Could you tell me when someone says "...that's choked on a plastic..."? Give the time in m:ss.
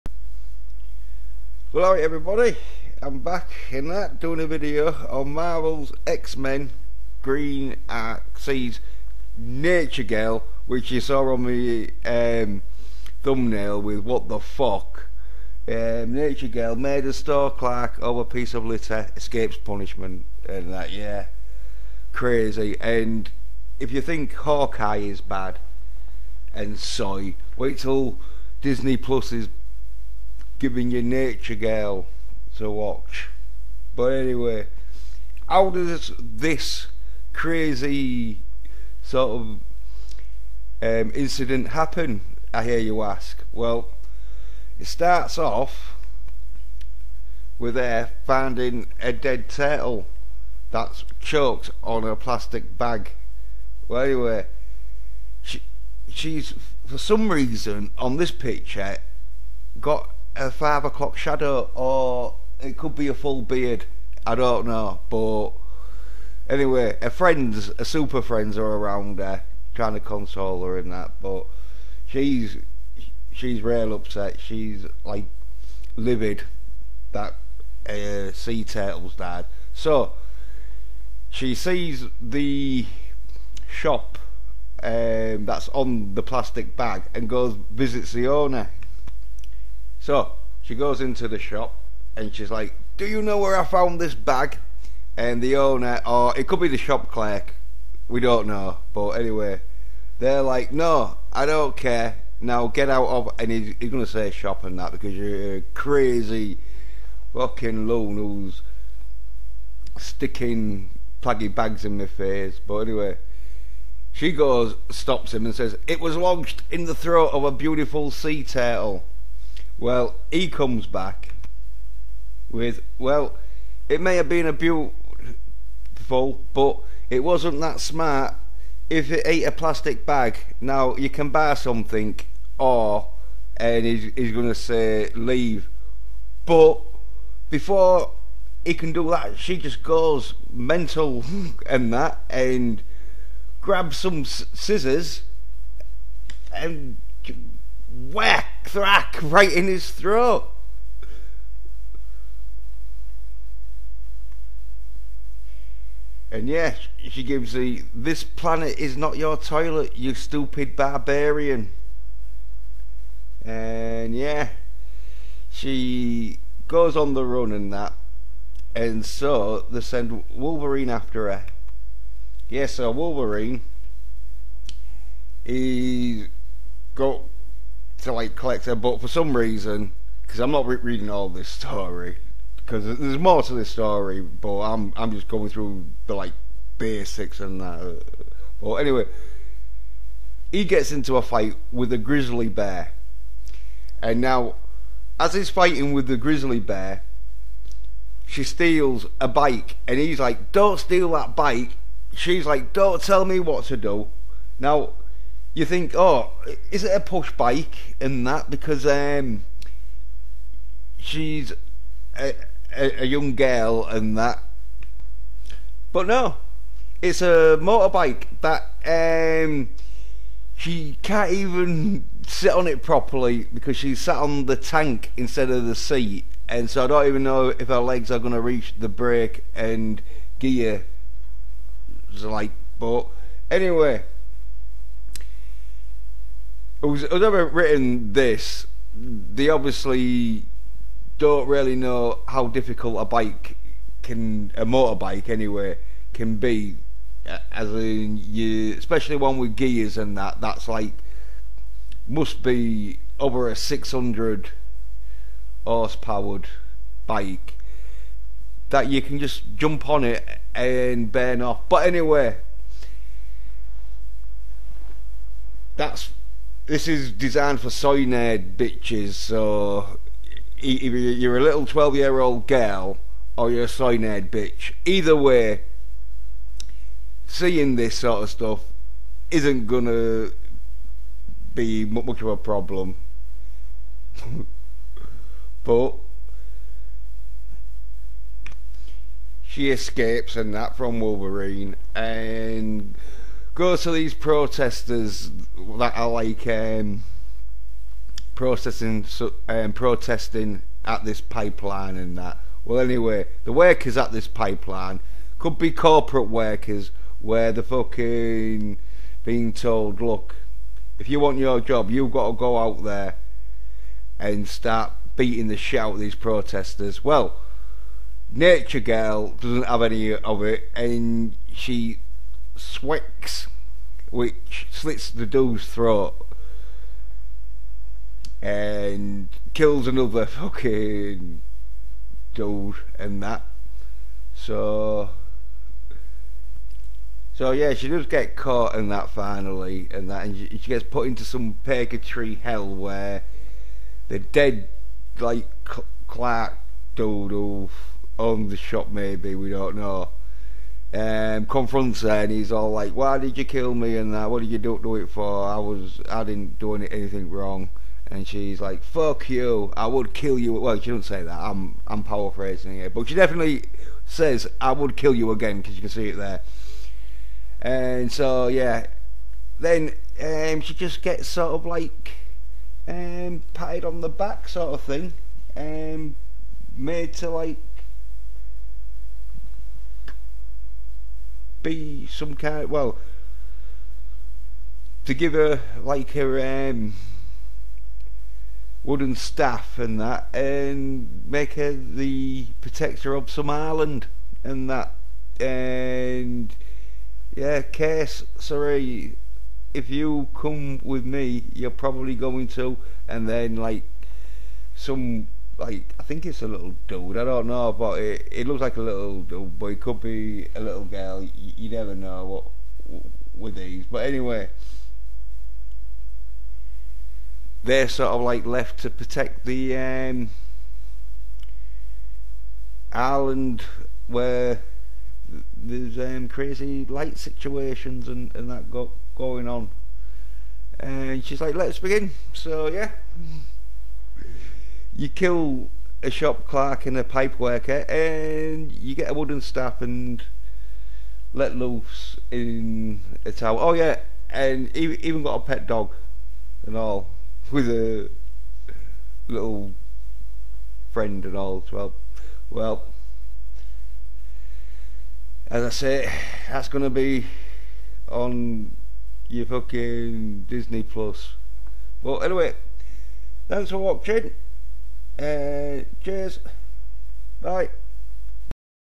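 0:50.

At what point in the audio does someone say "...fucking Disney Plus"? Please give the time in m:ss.
7:39.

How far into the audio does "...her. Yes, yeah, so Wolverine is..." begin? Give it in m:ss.
2:51.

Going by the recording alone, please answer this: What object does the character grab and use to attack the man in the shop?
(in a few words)
Scissors.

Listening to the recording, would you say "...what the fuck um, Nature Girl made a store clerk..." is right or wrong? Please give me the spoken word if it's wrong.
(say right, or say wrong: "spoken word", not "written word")
right.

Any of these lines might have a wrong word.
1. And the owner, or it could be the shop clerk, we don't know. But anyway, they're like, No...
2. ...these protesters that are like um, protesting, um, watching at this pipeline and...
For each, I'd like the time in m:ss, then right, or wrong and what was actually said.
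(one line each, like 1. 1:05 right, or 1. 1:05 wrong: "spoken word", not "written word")
1. 1:35 right
2. 4:53 wrong: "protesting", not "watching".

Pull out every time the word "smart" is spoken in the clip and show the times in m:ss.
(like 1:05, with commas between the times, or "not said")
2:07.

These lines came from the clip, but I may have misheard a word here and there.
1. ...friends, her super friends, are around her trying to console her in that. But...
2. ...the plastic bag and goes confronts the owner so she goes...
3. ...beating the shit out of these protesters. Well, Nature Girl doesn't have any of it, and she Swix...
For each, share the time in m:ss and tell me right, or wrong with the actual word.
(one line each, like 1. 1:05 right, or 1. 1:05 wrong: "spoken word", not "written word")
1. 1:07 right
2. 1:26 wrong: "visits", not "confronts"
3. 5:15 right.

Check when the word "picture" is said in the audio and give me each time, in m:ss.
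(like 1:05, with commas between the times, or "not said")
0:58.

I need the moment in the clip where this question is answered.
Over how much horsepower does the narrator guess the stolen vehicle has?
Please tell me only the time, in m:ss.
4:13.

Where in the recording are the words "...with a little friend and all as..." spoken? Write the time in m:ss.
7:27.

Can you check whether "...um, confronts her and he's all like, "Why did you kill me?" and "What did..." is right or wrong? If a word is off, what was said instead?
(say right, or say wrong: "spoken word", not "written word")
right.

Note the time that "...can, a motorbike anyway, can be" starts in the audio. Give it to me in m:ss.
4:04.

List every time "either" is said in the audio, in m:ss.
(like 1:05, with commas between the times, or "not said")
4:30, 4:34.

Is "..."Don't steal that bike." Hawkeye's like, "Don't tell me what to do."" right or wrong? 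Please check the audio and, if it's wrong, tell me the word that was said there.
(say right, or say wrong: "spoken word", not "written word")
wrong: "She", not "Hawkeye".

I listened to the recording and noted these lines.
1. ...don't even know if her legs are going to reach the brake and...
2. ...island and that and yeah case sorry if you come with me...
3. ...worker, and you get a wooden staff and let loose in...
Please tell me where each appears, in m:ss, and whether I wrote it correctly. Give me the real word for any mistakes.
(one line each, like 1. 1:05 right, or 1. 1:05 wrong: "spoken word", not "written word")
1. 3:46 right
2. 6:33 right
3. 7:17 right.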